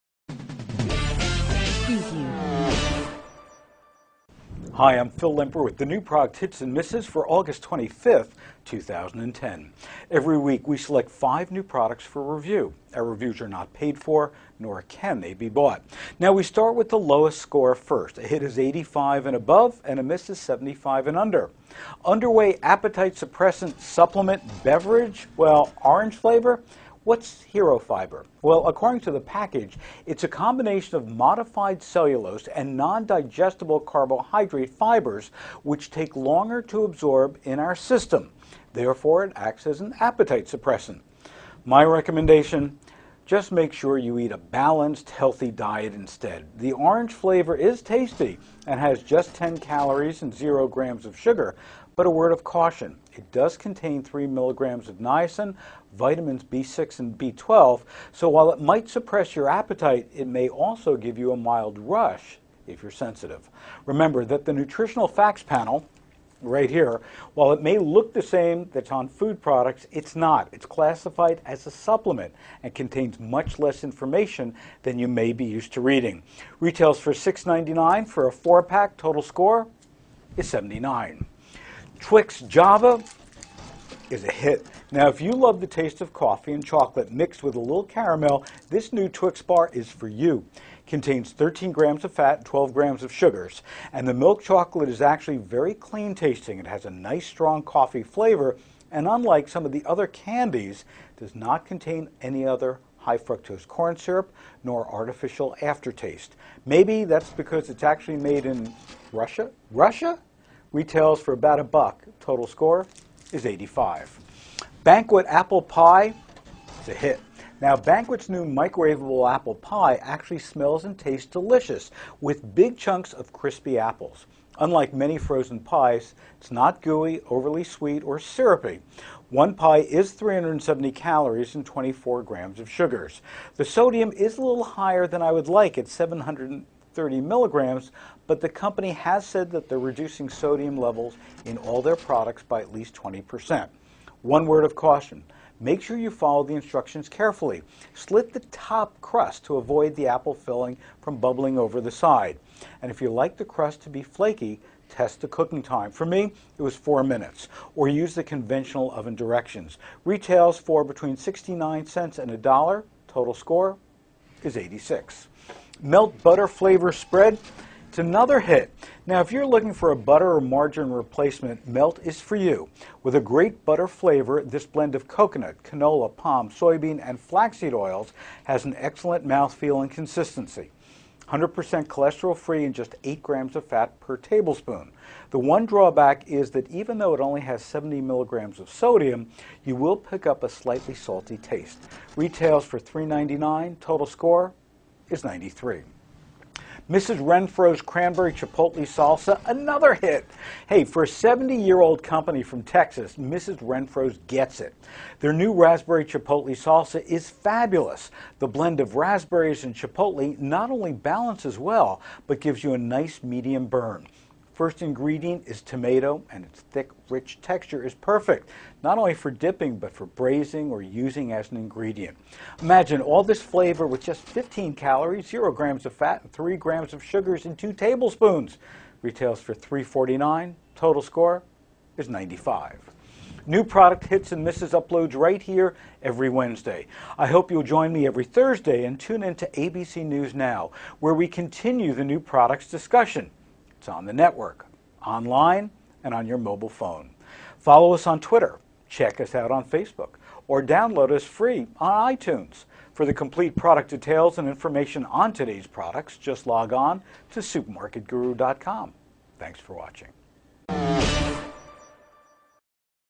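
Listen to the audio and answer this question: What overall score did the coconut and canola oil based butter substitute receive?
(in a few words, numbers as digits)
93.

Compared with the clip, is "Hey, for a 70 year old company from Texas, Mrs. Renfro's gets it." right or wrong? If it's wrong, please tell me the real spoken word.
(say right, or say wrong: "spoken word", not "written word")
right.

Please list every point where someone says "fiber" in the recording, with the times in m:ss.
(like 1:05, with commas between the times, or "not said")
0:27, 0:34.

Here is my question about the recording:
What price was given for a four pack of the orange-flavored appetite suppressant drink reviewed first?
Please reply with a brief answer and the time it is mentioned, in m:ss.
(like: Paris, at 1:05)
$6.99, at 1:17.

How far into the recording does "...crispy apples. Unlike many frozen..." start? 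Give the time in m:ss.
2:03.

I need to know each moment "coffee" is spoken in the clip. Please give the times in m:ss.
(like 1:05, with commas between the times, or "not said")
1:26, 1:37.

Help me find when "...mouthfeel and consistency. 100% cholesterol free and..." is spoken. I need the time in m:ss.
2:59.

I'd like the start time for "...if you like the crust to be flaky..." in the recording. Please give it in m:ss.
2:32.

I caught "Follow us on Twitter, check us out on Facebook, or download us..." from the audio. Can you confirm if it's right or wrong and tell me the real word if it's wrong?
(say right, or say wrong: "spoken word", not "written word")
right.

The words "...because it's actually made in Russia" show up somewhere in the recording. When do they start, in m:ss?
1:47.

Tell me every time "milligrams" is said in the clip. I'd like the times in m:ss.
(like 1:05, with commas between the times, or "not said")
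0:54, 2:17, 3:08.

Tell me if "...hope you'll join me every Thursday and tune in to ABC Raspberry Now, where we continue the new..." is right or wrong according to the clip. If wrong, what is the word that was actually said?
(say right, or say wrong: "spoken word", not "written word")
wrong: "News", not "Raspberry".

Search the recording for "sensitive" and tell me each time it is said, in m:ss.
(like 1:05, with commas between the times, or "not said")
1:02.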